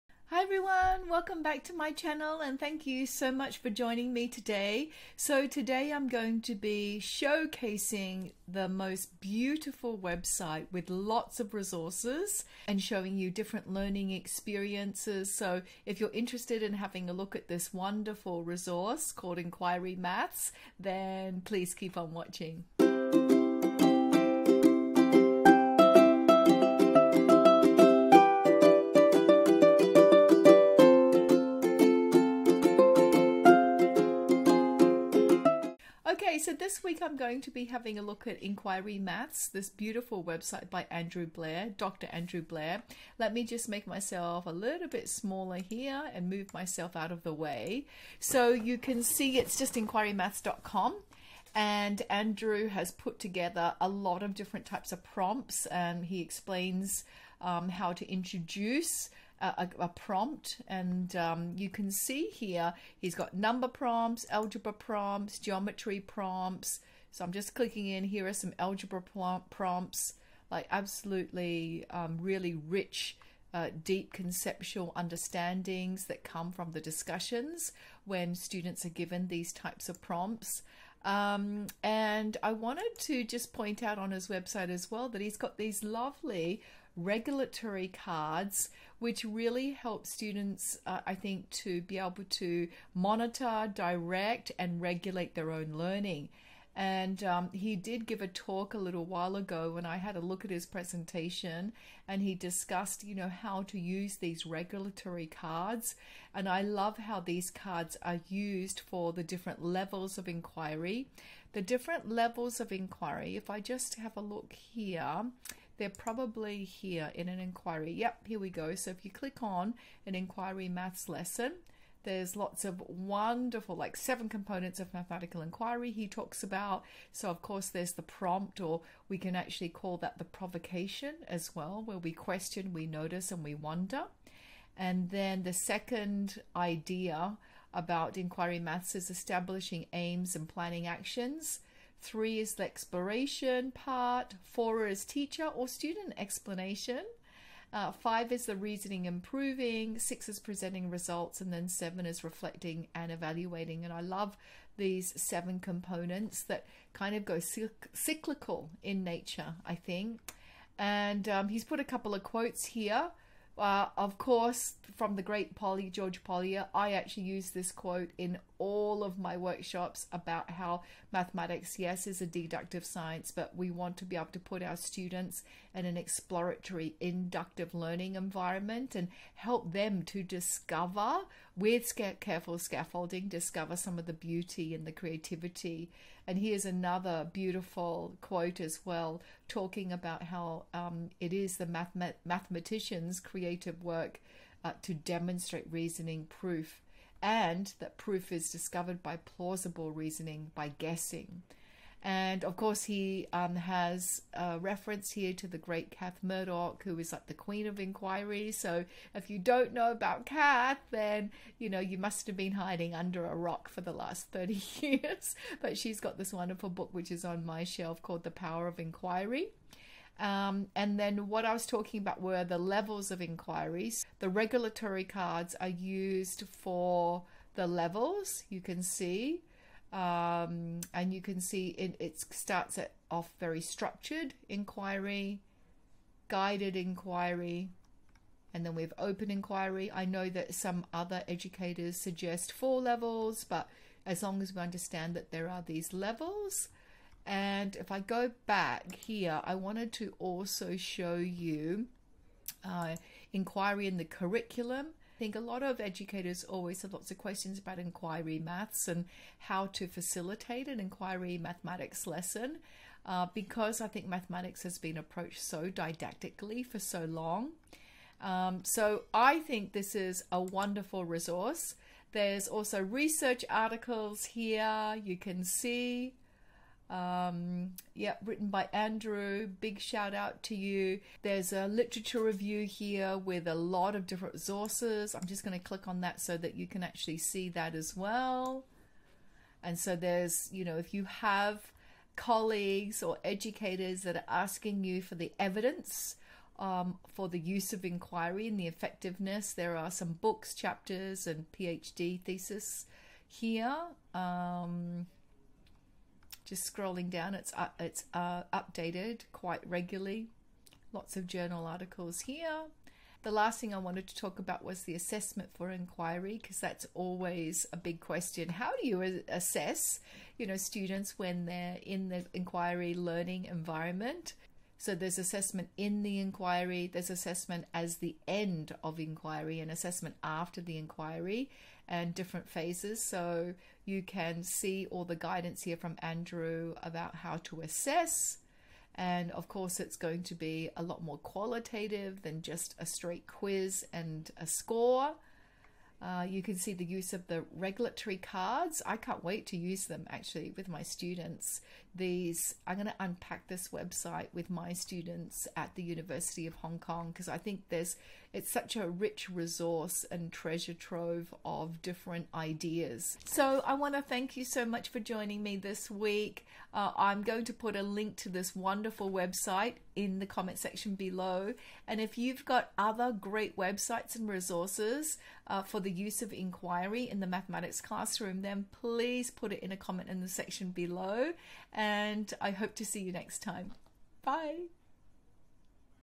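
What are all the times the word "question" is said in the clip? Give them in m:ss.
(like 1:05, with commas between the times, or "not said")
2:12, 4:17, 5:18.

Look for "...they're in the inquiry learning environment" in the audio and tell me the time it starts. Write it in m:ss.
5:21.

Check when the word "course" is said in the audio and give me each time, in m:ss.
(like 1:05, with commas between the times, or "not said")
2:07, 2:44, 3:22, 5:39.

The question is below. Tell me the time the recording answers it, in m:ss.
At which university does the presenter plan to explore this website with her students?
5:55.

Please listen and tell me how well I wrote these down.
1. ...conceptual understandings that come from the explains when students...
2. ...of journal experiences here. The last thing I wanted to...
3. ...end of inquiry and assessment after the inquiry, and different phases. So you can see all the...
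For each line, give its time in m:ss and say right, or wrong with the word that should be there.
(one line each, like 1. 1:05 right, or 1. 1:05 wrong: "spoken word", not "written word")
1. 1:14 wrong: "discussions", not "explains"
2. 5:11 wrong: "articles", not "experiences"
3. 5:28 right.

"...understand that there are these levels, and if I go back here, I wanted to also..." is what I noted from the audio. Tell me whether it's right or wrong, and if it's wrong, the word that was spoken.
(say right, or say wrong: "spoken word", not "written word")
right.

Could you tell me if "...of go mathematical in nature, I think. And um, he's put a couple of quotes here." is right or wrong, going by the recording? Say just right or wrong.
wrong.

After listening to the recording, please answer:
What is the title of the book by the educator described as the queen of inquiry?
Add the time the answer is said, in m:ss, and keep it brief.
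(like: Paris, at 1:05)
The Power of Inquiry, at 3:38.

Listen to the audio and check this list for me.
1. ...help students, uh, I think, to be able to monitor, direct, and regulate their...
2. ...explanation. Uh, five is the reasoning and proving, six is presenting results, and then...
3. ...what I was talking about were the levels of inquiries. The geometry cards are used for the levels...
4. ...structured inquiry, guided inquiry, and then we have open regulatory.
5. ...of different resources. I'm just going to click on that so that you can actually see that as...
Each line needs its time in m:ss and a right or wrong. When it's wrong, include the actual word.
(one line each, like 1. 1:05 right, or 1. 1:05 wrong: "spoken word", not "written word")
1. 1:29 right
2. 2:26 right
3. 3:41 wrong: "regulatory", not "geometry"
4. 3:53 wrong: "inquiry", not "regulatory"
5. 4:43 right.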